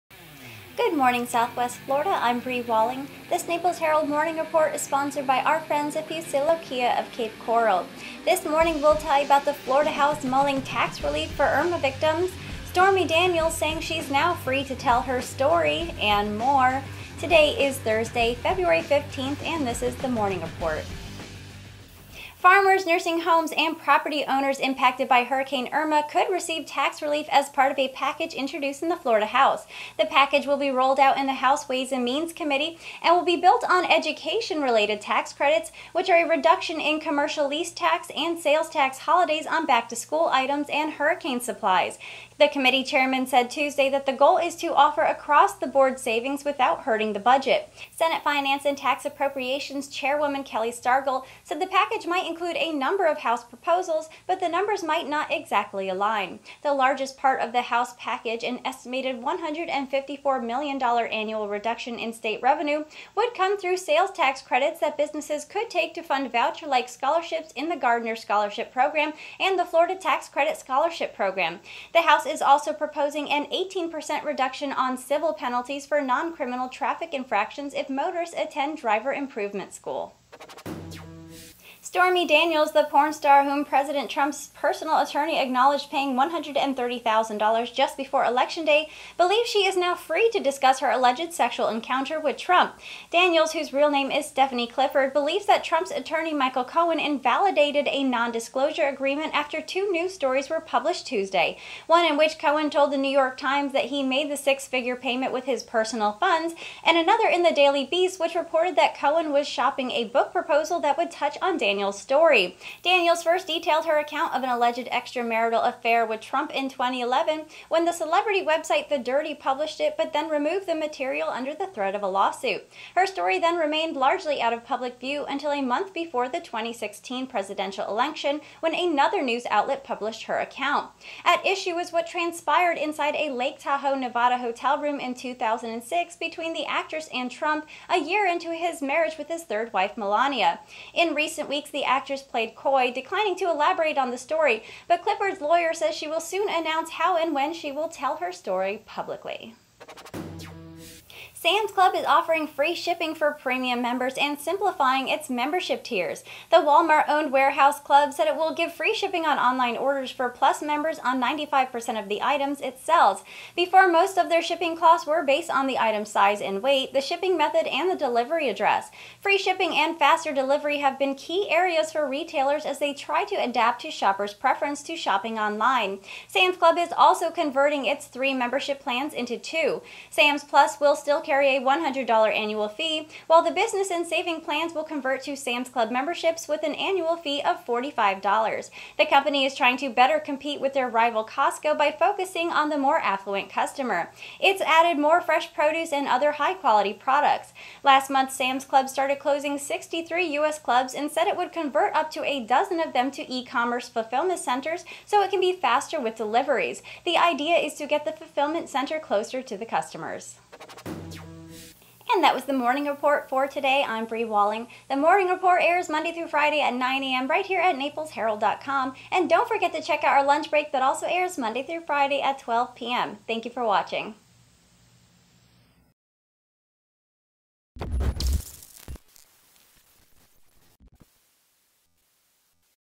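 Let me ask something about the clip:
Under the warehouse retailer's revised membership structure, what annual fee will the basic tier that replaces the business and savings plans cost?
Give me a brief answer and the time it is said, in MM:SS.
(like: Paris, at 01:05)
$45, at 03:07.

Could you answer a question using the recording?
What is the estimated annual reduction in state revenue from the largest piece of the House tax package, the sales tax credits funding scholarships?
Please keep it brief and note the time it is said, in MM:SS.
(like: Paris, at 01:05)
$154 million, at 00:59.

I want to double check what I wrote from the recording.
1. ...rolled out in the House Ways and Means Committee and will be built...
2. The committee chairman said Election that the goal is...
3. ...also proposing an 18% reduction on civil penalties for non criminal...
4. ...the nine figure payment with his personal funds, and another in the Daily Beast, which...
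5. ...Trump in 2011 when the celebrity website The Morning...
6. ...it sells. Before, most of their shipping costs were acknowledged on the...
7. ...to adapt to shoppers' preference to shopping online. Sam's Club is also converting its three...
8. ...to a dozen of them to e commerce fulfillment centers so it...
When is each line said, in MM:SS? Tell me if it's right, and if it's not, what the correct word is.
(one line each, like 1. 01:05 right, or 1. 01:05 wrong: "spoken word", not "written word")
1. 00:30 right
2. 00:42 wrong: "Tuesday", not "Election"
3. 01:12 right
4. 01:44 wrong: "six", not "nine"
5. 01:56 wrong: "Dirty", not "Morning"
6. 02:42 wrong: "based", not "acknowledged"
7. 02:53 right
8. 03:22 right.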